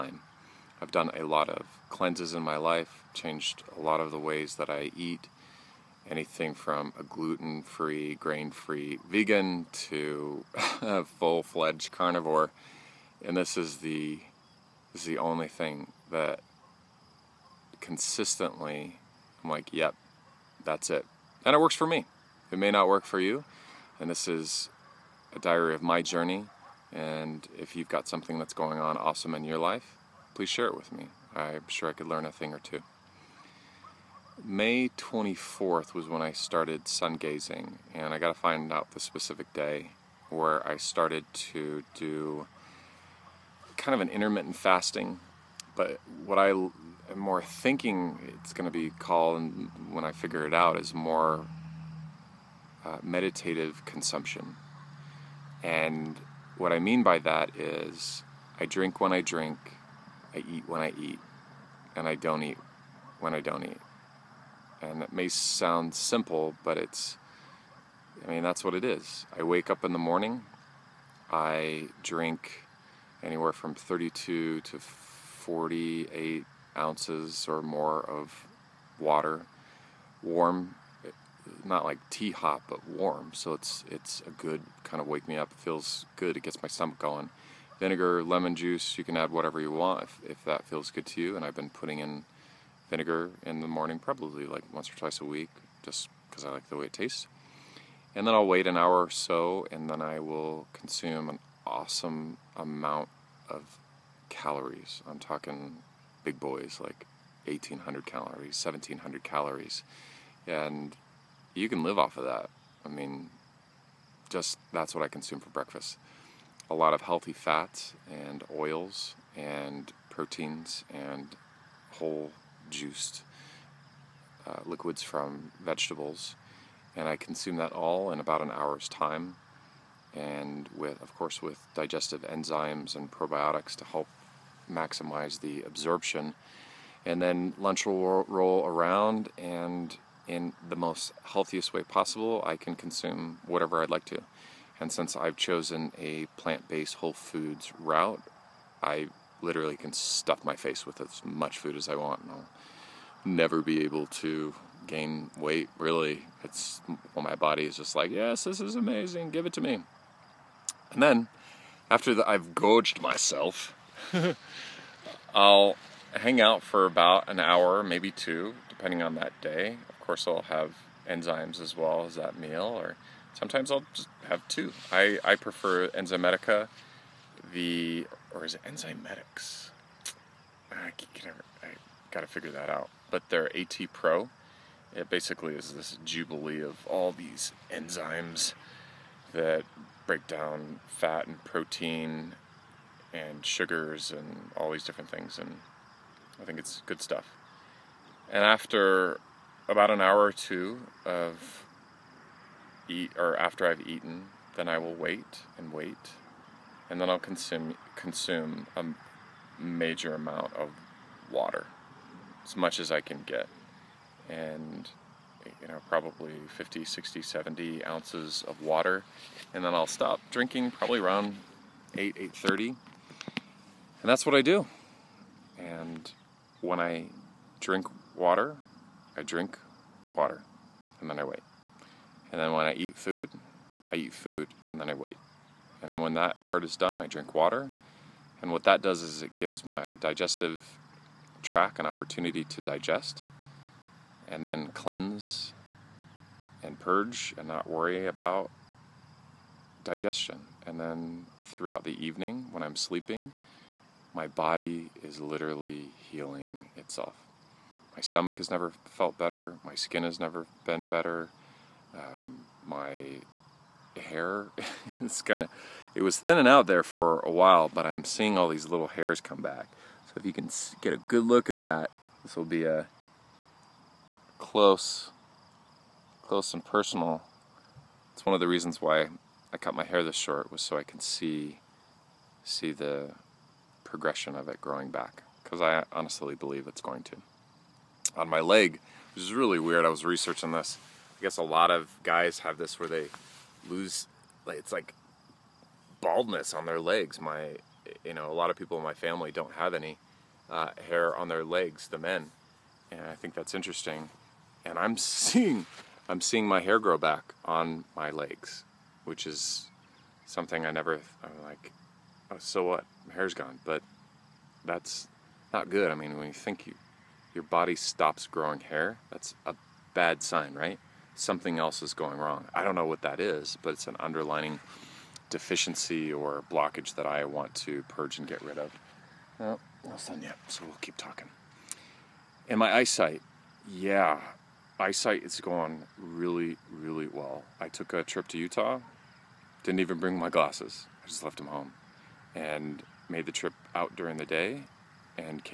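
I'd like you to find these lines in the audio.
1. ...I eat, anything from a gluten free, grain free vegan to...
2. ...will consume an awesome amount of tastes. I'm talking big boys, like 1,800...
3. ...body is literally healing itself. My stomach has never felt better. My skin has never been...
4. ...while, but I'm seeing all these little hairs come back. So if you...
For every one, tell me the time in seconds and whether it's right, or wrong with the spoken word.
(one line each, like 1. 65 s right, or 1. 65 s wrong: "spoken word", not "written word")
1. 4 s right
2. 100 s wrong: "calories", not "tastes"
3. 254 s right
4. 267 s right.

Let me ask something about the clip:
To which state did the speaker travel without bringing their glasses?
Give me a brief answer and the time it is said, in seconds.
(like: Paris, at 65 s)
Utah, at 338 s.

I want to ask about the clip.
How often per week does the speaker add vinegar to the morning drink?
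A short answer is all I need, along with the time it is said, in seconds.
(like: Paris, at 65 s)
once or twice, at 94 s.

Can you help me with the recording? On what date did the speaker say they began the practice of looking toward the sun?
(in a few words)
May 24th.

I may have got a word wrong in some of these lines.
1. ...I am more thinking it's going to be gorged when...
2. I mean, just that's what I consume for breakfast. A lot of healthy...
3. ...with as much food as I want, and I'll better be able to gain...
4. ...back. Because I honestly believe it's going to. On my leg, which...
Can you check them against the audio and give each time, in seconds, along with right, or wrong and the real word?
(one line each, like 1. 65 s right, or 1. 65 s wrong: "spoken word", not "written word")
1. 46 s wrong: "called", not "gorged"
2. 112 s right
3. 150 s wrong: "never", not "better"
4. 284 s right.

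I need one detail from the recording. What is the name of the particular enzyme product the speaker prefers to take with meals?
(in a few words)
AT Pro.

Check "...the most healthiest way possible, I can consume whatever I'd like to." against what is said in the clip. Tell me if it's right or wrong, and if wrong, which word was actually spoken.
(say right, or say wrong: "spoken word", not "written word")
right.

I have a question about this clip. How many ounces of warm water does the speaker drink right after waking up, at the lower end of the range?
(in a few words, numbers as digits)
32.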